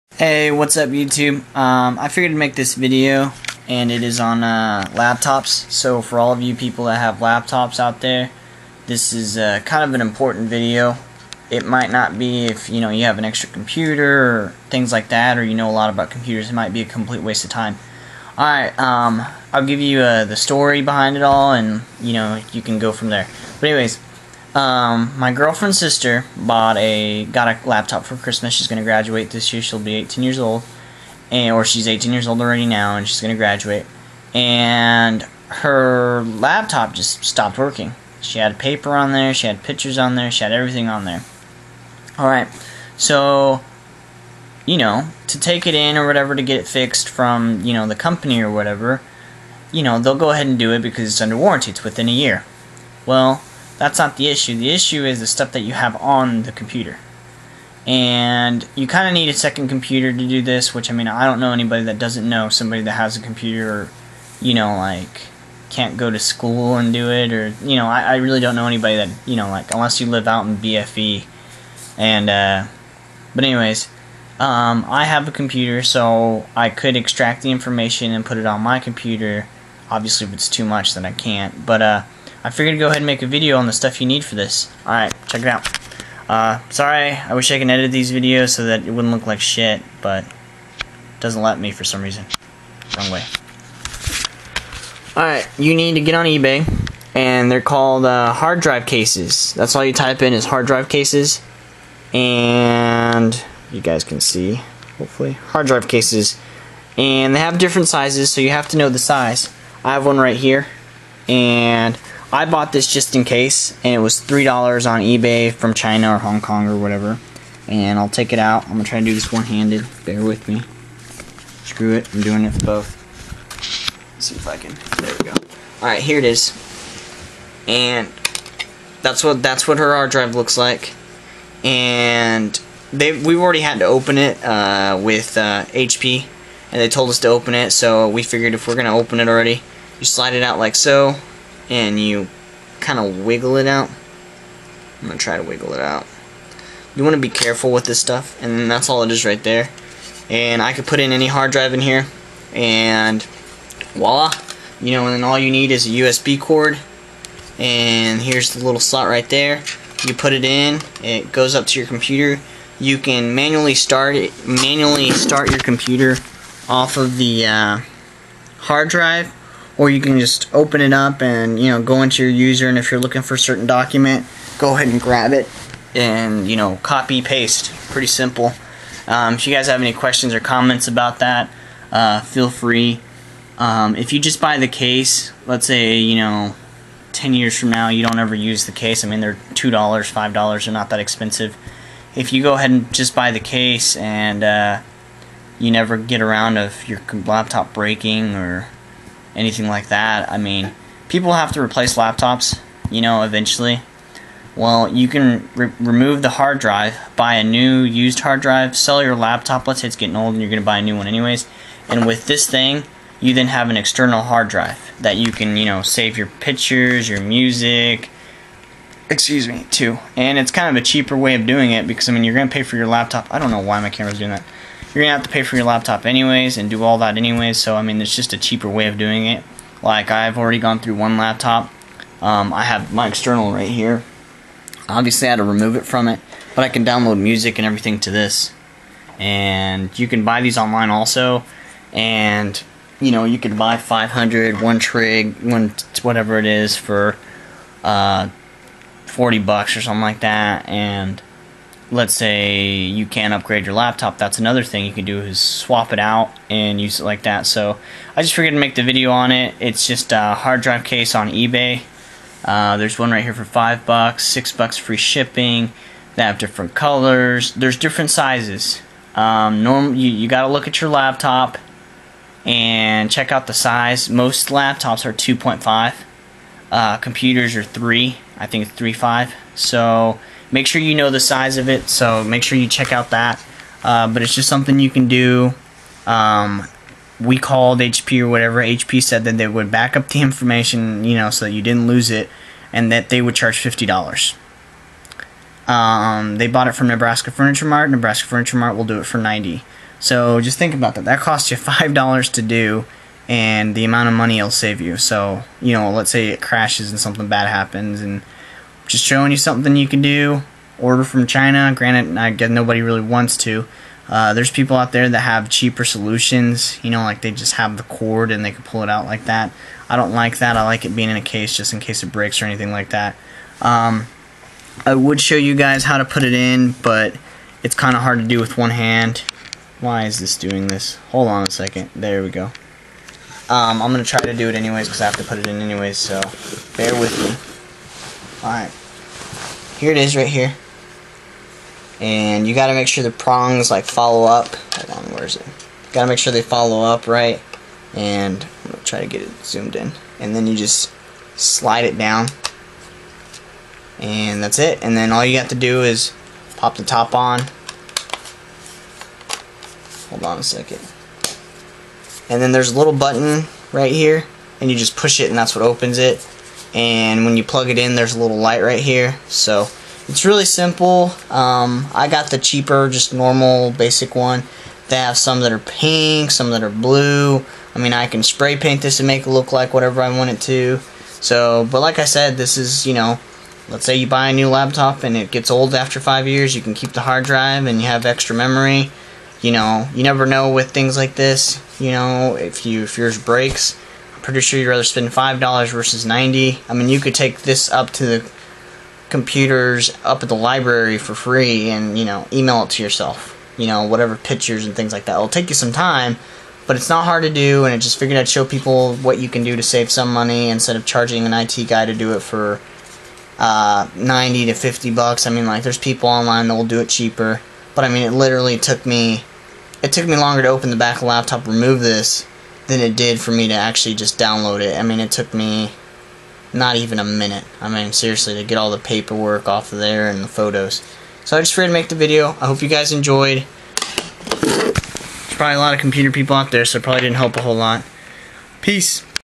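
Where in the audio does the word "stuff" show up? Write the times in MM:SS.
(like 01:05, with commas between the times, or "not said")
00:55, 01:23, 02:27.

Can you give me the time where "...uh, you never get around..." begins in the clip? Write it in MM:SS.
03:14.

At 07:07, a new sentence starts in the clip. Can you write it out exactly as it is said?
I mean, seriously, to get all the paperwork off of there and the photos.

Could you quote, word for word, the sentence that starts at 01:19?
Obviously, if it's too much, then I can't.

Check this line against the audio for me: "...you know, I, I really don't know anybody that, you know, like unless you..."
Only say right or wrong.
right.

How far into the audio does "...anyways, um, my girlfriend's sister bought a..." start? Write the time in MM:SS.
00:23.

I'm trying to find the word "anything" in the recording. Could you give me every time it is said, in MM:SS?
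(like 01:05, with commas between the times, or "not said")
03:19, 05:22.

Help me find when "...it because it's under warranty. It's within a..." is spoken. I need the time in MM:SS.
00:50.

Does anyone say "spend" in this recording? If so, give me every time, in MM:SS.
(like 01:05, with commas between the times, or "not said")
06:34.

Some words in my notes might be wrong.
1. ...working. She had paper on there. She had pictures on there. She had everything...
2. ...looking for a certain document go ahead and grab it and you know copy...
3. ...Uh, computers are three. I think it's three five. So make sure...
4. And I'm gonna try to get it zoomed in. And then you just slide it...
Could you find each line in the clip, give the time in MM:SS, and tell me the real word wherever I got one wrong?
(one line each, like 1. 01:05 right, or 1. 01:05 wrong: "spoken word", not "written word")
1. 00:37 right
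2. 02:52 right
3. 04:36 right
4. 05:47 right.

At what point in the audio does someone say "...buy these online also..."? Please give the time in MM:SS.
04:00.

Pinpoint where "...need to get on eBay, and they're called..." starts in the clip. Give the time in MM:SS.
01:35.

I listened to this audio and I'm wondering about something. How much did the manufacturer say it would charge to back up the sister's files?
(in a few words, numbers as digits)
$50.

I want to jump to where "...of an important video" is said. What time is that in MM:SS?
00:09.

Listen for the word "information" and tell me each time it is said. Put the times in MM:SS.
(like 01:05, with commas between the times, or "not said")
01:17, 04:50.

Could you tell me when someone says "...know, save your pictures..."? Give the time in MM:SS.
03:35.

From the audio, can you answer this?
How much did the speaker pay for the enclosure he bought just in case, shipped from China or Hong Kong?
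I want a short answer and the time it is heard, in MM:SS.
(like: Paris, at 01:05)
$3, at 01:54.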